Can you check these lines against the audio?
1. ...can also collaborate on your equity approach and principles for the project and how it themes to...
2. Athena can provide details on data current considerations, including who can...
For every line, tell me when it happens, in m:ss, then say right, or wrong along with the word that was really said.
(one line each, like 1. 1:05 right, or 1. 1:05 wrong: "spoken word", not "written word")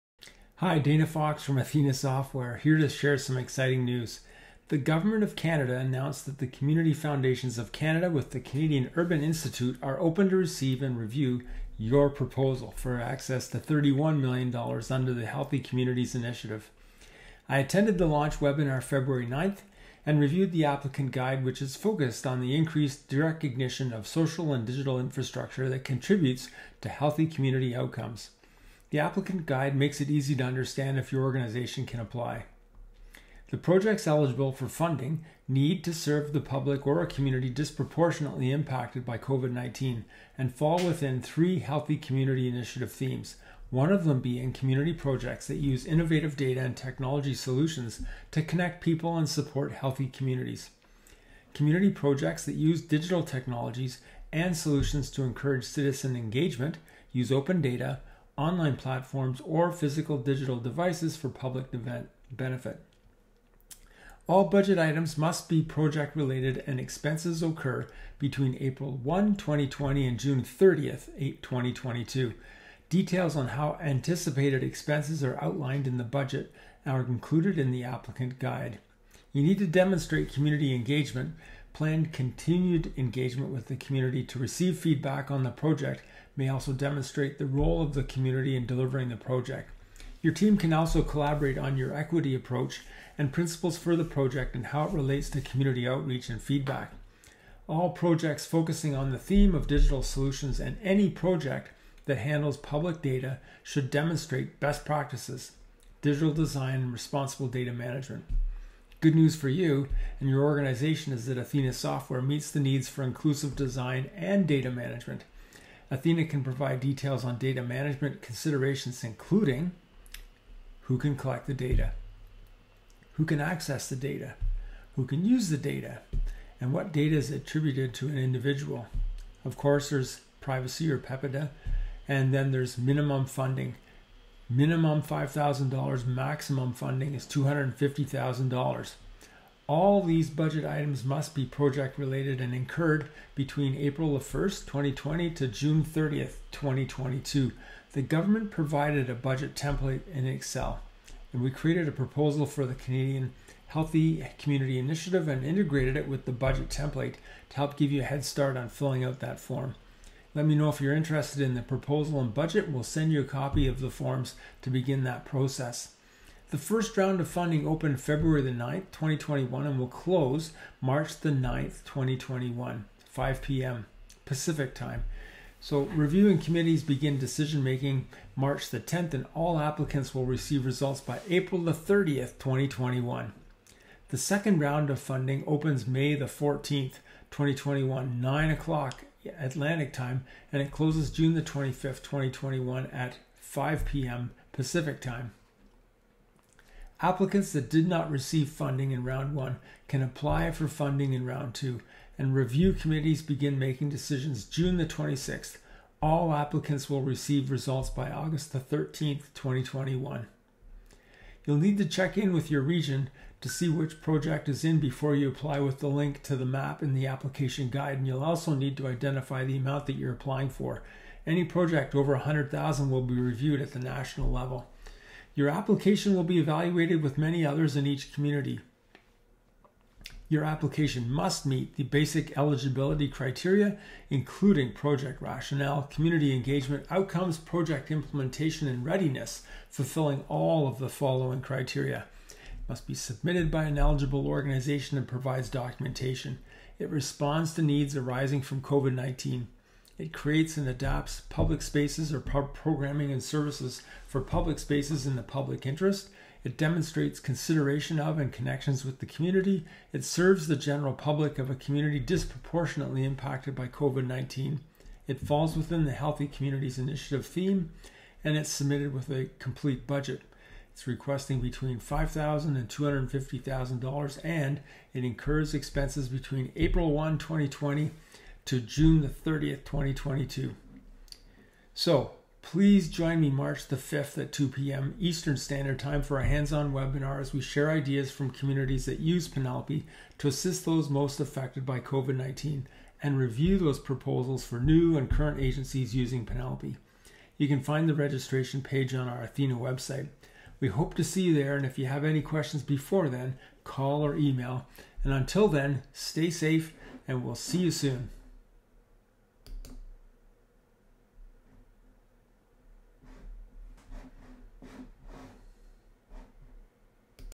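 1. 1:30 wrong: "relates", not "themes"
2. 1:55 wrong: "management", not "current".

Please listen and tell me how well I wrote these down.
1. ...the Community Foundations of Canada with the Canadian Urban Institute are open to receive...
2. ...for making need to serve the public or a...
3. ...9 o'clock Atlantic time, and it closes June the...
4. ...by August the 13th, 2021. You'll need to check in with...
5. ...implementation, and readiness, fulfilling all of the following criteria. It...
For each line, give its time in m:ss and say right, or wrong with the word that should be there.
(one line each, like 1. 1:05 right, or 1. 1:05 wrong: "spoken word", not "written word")
1. 0:06 right
2. 0:34 wrong: "funding", not "making"
3. 3:08 right
4. 3:27 right
5. 3:57 right.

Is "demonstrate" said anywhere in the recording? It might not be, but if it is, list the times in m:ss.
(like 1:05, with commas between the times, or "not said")
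1:19, 1:26, 1:43, 4:16.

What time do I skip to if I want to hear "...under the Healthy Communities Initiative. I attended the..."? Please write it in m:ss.
0:14.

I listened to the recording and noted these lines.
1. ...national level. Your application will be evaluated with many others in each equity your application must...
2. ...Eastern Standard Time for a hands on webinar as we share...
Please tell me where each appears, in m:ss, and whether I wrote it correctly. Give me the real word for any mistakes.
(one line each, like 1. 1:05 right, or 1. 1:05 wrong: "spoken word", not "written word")
1. 3:43 wrong: "community", not "equity"
2. 4:44 right.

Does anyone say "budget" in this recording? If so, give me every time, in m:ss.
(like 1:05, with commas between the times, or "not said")
1:04, 1:16, 2:20, 2:29, 2:36, 2:42, 4:29.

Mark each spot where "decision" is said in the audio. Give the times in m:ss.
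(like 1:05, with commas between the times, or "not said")
2:57, 3:23.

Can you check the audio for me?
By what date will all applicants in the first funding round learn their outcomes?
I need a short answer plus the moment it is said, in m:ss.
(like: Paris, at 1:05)
April 30, 2021, at 3:01.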